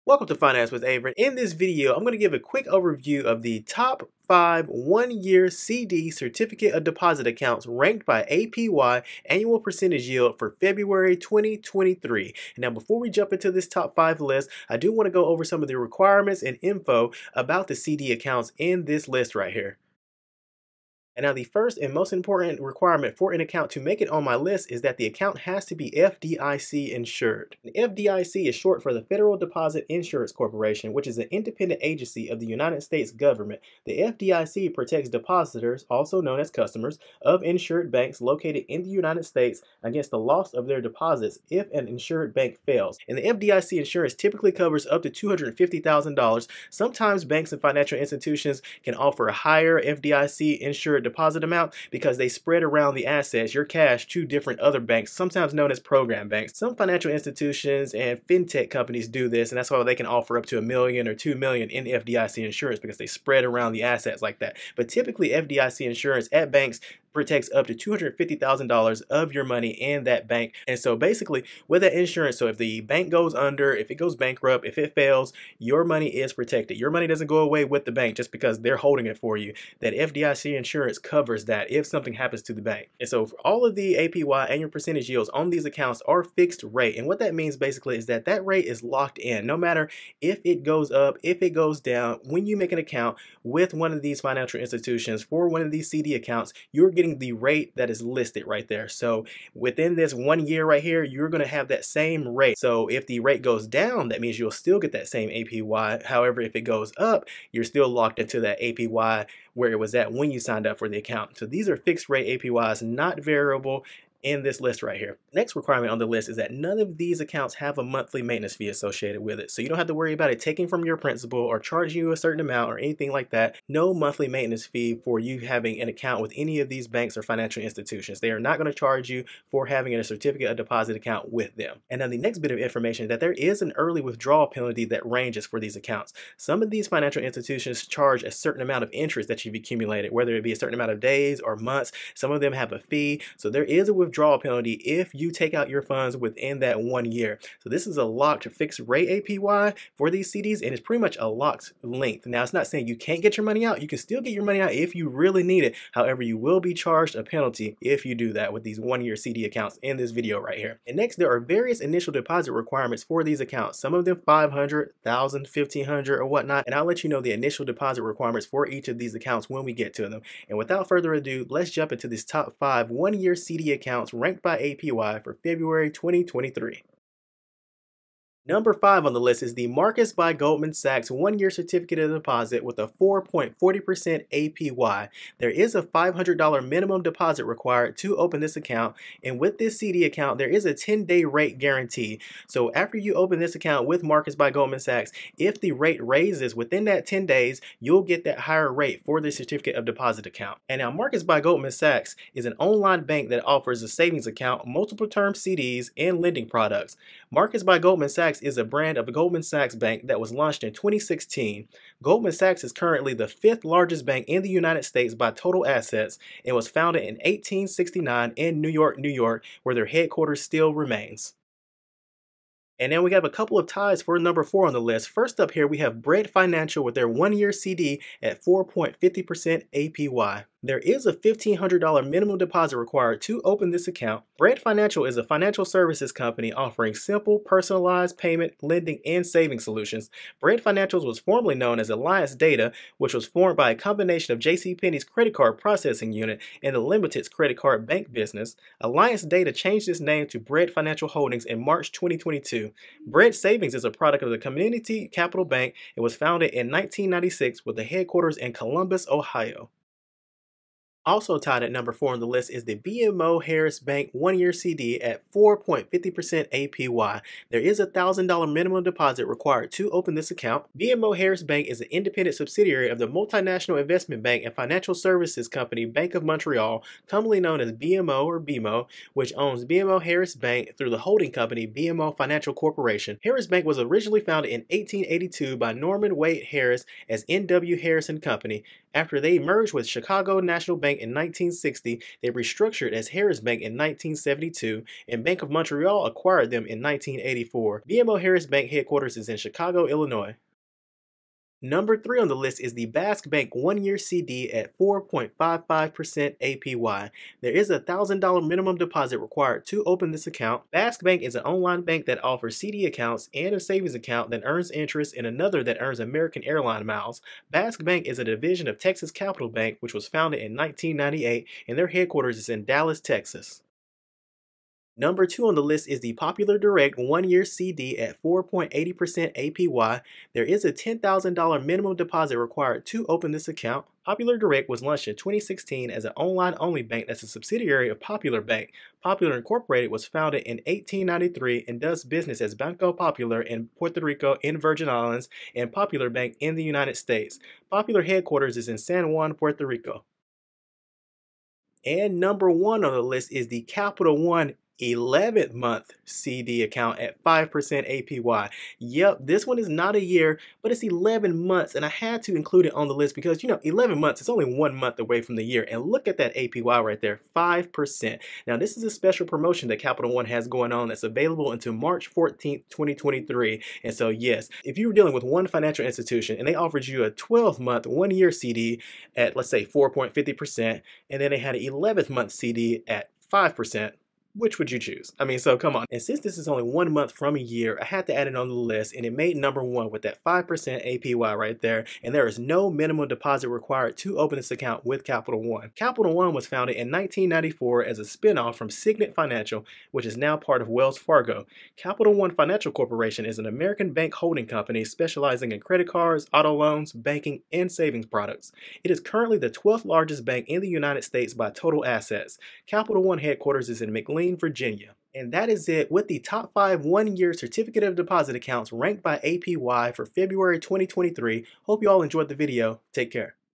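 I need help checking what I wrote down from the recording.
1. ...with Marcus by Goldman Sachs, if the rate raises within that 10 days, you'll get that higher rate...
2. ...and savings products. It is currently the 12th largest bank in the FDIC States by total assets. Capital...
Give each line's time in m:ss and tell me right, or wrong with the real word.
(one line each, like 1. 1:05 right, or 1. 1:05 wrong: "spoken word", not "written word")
1. 3:13 right
2. 6:47 wrong: "United", not "FDIC".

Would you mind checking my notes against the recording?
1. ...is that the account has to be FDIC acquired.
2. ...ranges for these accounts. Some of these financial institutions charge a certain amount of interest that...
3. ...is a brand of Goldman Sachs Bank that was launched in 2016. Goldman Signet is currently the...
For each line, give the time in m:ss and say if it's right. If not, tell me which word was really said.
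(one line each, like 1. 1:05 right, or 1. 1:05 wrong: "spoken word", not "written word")
1. 0:24 wrong: "insured", not "acquired"
2. 2:15 right
3. 3:28 wrong: "Sachs", not "Signet".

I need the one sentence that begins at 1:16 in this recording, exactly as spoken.
Your money doesn't go away with the bank just because they're holding it for you.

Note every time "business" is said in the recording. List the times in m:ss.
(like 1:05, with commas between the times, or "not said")
4:08, 5:42.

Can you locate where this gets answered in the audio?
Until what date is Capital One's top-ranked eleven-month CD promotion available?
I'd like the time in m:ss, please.
6:11.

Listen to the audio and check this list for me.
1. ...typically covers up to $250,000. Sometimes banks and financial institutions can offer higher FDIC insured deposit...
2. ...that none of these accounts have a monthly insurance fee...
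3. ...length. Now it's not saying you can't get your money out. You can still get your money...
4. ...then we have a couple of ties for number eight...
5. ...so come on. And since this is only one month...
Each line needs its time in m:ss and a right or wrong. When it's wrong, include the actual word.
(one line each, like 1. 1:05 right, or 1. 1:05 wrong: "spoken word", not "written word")
1. 0:44 right
2. 1:56 wrong: "maintenance", not "insurance"
3. 2:31 right
4. 3:42 wrong: "four", not "eight"
5. 6:25 right.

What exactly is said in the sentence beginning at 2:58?
Number five on the list is the Marcus by Goldman Sachs one year certificate of deposit with a 4.40% APY.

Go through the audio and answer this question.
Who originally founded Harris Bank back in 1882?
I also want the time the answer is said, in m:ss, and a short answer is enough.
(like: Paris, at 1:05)
Norman Wade Harris, at 4:45.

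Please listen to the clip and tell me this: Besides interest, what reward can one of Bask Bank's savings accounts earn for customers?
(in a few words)
American airline miles.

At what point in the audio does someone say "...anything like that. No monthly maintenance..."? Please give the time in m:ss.
2:02.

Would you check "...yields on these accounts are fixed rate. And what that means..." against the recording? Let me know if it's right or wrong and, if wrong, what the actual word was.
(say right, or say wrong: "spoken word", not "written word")
right.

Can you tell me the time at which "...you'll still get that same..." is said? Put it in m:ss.
1:44.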